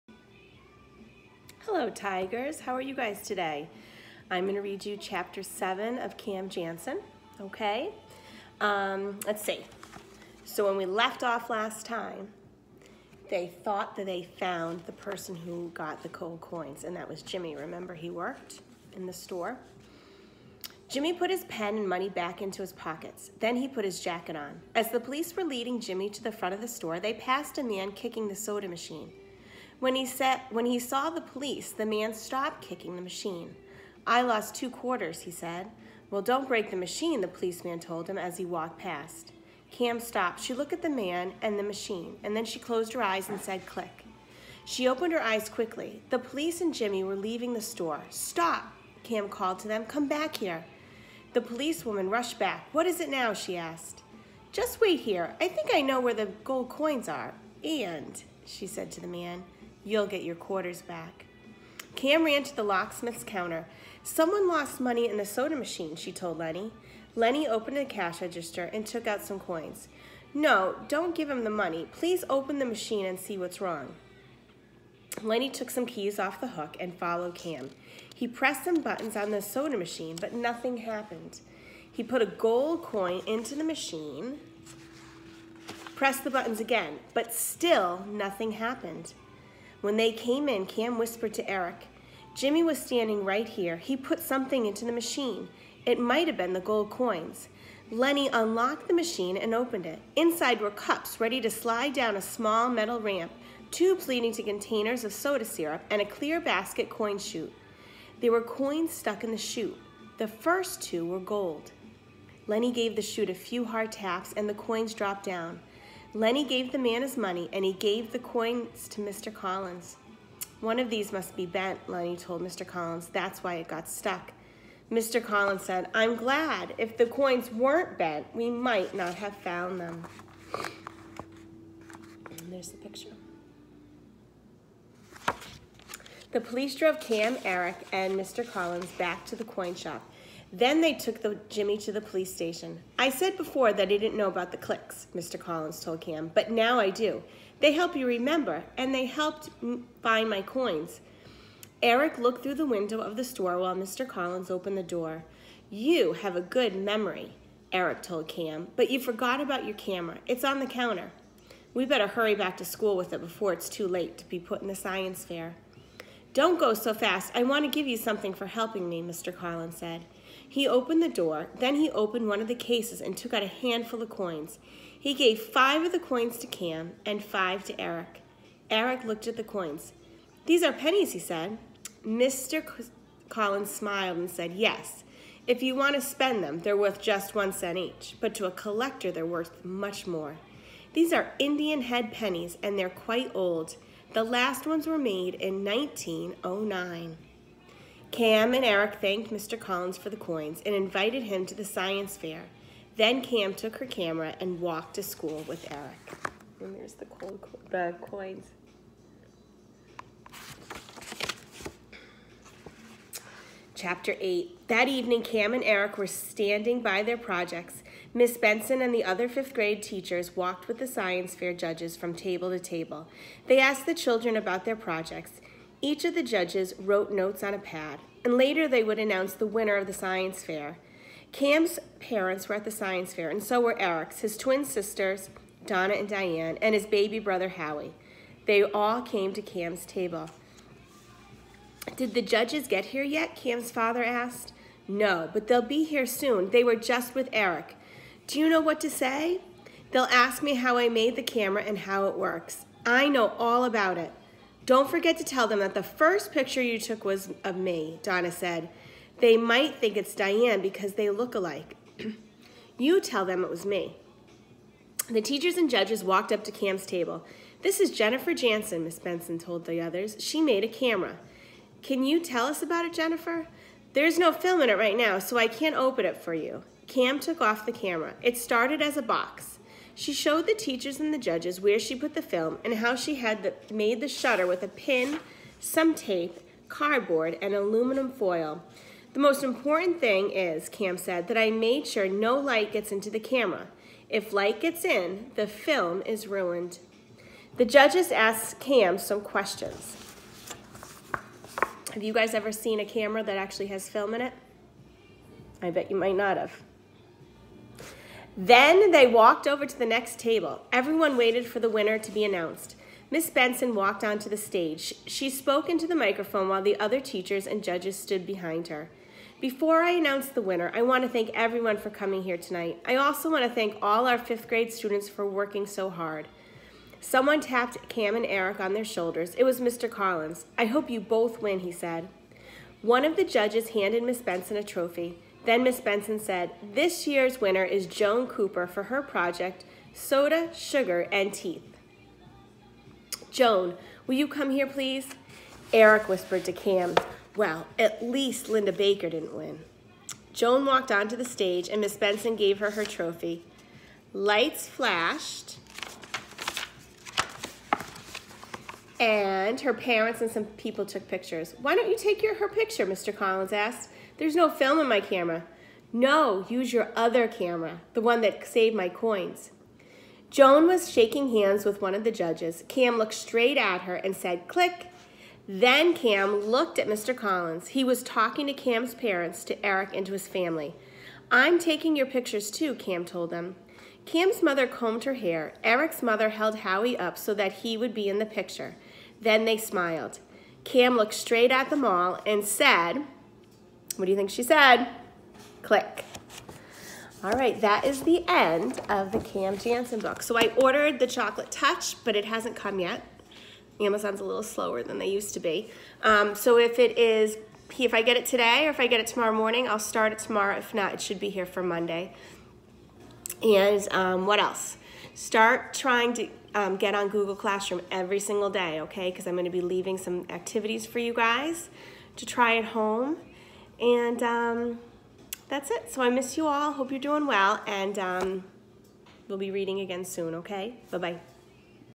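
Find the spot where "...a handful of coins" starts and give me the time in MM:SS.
02:53.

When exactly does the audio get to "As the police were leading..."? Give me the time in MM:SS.
00:24.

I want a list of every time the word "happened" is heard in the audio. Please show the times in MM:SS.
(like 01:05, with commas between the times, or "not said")
01:20, 01:28.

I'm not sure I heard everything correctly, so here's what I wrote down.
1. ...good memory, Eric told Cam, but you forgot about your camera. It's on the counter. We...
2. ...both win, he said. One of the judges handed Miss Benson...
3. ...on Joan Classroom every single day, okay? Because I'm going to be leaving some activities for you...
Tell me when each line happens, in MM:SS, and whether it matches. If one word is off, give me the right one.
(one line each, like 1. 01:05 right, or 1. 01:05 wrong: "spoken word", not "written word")
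1. 02:36 right
2. 05:30 right
3. 06:56 wrong: "Google", not "Joan".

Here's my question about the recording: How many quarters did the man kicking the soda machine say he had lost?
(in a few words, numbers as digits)
2.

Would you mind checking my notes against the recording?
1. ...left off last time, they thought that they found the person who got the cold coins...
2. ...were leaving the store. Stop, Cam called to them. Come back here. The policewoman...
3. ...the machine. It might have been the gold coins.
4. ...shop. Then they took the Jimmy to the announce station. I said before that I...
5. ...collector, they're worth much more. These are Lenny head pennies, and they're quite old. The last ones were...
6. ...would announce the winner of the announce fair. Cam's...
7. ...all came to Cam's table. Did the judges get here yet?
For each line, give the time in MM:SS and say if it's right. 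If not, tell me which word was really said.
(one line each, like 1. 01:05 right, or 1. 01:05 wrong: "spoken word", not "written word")
1. 00:10 right
2. 00:47 right
3. 01:34 right
4. 02:19 wrong: "police", not "announce"
5. 03:08 wrong: "Indian", not "Lenny"
6. 03:48 wrong: "science", not "announce"
7. 03:58 right.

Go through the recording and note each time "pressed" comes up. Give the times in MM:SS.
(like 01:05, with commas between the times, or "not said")
01:18, 01:25.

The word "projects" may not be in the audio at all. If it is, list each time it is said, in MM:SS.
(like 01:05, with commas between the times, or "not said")
03:37, 03:44, 05:39.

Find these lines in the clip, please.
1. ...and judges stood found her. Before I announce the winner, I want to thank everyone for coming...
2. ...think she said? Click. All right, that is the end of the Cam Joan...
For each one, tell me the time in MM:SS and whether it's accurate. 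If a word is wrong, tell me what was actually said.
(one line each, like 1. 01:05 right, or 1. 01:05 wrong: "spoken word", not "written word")
1. 05:17 wrong: "behind", not "found"
2. 06:34 wrong: "Jansen", not "Joan".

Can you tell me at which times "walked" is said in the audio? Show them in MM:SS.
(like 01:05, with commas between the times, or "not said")
00:38, 03:24, 03:40, 04:26, 05:09, 05:13, 05:50.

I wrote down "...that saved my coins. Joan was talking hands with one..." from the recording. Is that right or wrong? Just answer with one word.
wrong.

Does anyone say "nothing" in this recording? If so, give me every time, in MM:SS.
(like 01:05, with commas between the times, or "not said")
01:20, 01:28.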